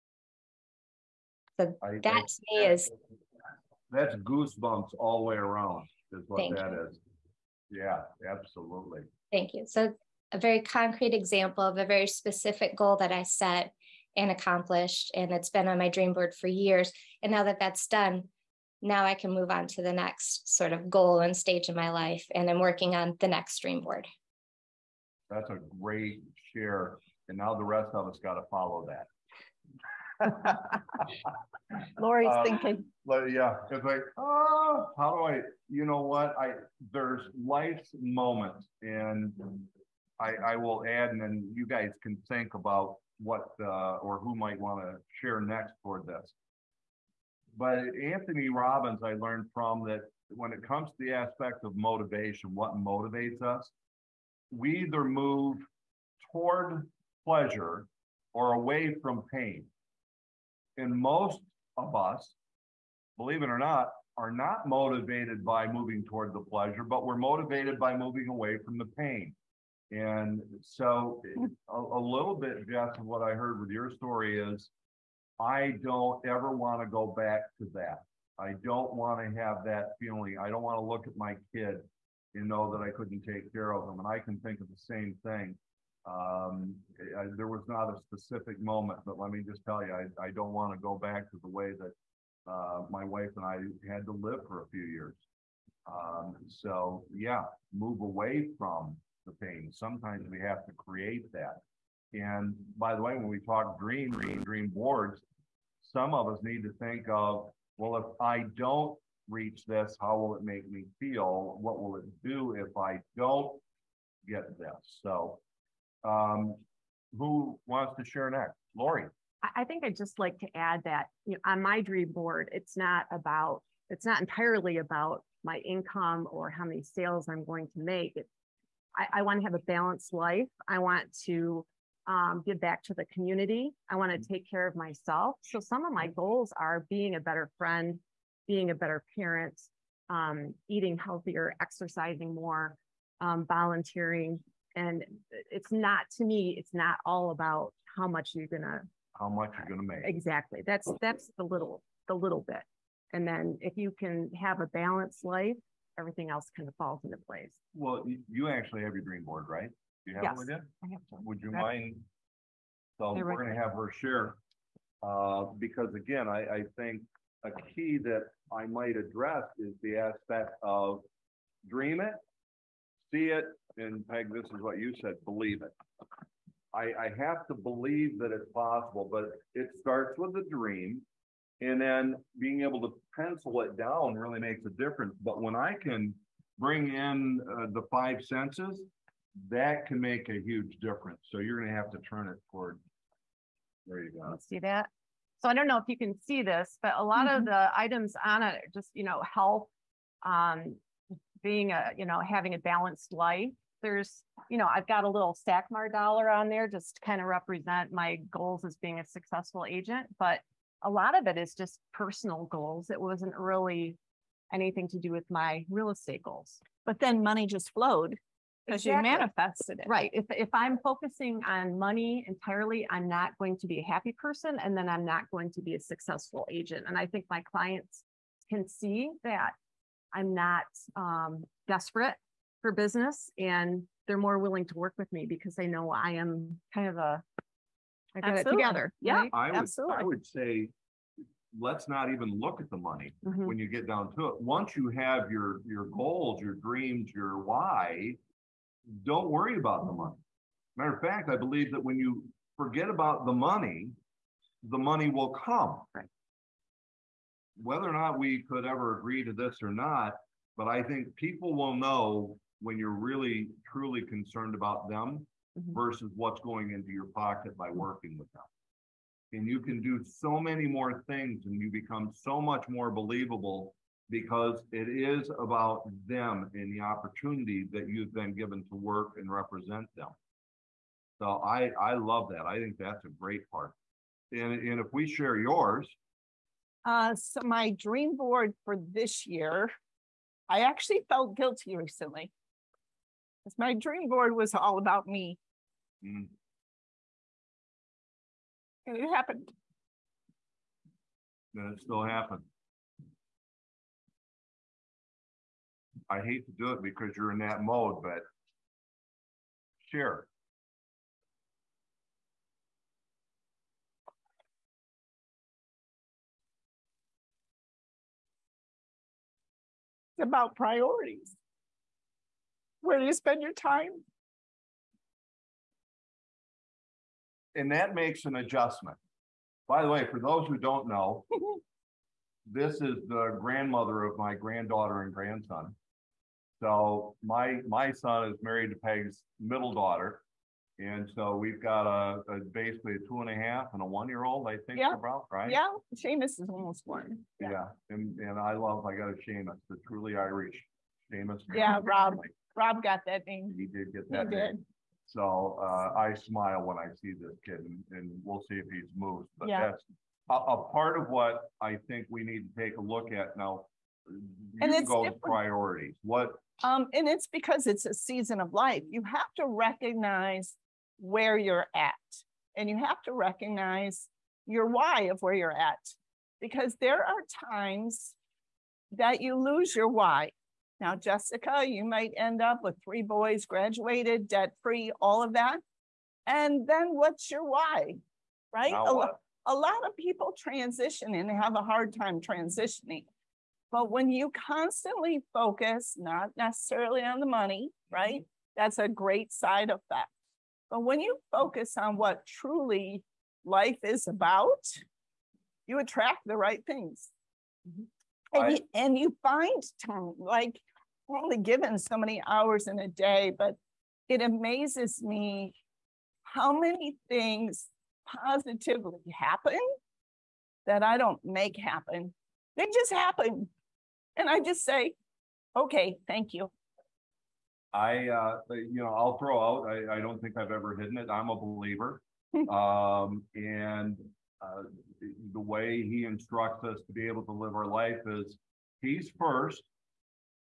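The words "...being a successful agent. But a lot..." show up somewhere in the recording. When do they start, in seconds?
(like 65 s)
208 s.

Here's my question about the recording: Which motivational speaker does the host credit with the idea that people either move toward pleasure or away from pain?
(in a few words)
Anthony Robbins.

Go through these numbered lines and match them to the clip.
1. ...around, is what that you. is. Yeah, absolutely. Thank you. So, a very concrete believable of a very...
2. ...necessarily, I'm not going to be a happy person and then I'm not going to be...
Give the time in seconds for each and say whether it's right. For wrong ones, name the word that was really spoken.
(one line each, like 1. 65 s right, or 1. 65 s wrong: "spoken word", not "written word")
1. 5 s wrong: "example", not "believable"
2. 222 s wrong: "entirely", not "necessarily".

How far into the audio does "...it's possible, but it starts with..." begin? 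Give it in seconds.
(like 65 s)
178 s.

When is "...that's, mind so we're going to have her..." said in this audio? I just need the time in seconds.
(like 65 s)
161 s.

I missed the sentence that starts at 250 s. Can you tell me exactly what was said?
Matter of fact, I believe that when you forget about the money, the money will come.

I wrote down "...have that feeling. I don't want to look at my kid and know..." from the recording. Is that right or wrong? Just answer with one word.
right.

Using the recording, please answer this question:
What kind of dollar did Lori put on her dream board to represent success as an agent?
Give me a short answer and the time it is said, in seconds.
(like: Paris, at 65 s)
Stackmar dollar, at 205 s.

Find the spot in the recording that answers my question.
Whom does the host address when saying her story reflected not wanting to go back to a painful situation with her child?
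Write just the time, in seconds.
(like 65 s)
72 s.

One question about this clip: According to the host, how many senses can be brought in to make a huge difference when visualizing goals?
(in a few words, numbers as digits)
5.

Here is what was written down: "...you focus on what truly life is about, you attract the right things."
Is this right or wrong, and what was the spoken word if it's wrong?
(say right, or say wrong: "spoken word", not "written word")
right.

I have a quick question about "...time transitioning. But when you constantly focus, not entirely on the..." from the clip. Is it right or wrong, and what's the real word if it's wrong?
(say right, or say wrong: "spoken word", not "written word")
wrong: "necessarily", not "entirely".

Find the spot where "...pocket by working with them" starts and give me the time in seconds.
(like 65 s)
267 s.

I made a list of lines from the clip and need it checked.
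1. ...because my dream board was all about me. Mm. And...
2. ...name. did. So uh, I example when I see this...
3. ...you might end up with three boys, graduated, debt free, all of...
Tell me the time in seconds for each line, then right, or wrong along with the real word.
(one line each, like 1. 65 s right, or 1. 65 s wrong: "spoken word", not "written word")
1. 293 s right
2. 354 s wrong: "smile", not "example"
3. 381 s right.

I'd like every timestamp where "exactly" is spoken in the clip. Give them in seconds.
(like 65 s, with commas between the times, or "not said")
150 s, 218 s.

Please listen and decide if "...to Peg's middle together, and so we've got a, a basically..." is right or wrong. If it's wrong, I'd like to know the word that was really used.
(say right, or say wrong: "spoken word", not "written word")
wrong: "daughter", not "together".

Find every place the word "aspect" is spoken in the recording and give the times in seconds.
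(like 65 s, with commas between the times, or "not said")
51 s, 169 s.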